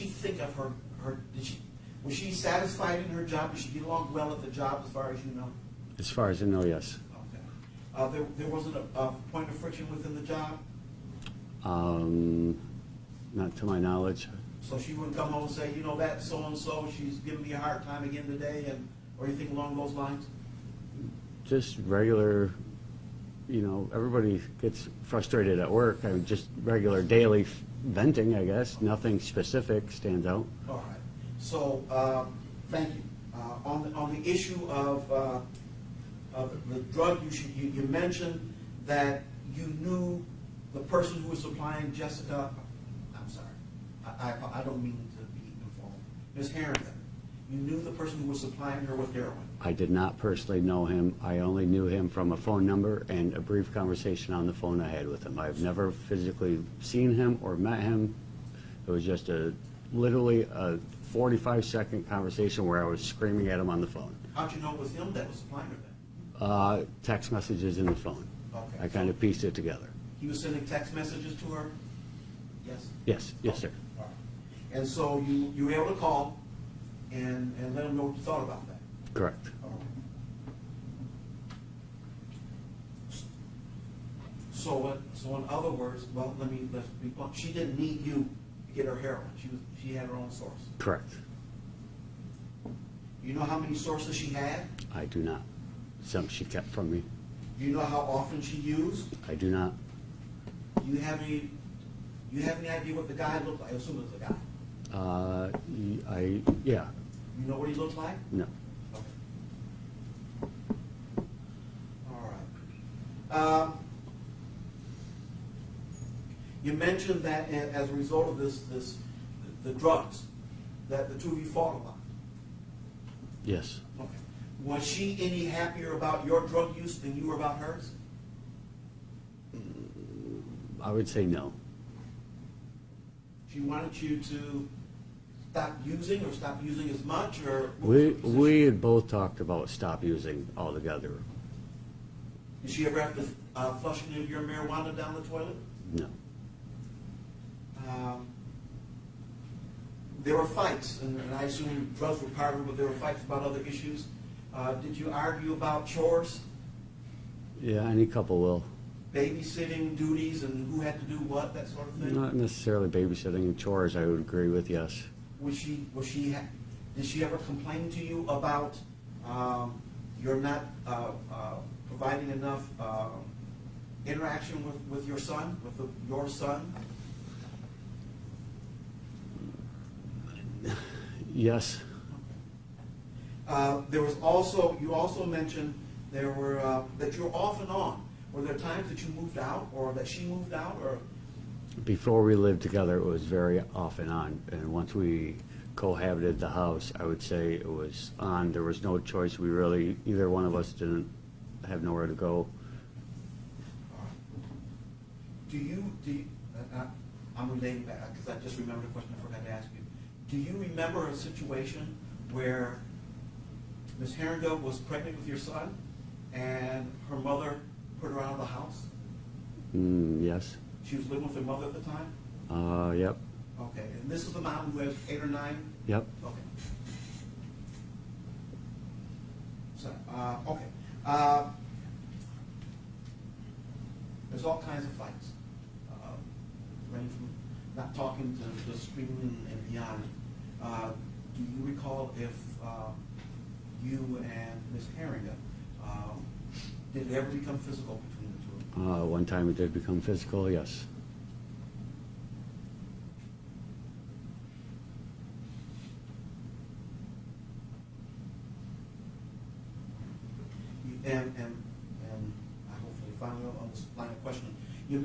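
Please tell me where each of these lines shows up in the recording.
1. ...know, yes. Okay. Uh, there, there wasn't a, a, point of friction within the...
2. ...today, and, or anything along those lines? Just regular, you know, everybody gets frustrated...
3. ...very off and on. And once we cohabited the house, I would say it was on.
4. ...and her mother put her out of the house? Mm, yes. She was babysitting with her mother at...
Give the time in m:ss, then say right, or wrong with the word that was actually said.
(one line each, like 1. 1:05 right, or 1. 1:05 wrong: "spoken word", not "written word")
1. 0:06 right
2. 0:18 right
3. 3:13 right
4. 3:36 wrong: "living", not "babysitting".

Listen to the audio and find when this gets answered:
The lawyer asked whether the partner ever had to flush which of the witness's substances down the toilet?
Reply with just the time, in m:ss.
2:24.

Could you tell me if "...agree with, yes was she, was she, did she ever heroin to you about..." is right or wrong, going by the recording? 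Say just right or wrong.
wrong.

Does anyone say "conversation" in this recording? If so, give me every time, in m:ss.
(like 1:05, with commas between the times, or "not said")
0:53, 1:02.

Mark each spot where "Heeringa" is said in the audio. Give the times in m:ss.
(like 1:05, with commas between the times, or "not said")
3:34, 4:04.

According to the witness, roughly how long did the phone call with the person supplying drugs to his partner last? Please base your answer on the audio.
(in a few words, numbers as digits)
45 seconds.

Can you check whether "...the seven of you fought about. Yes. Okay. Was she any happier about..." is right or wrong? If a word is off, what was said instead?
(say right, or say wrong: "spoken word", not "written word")
wrong: "two", not "seven".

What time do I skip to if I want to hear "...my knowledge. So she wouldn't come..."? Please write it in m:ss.
0:13.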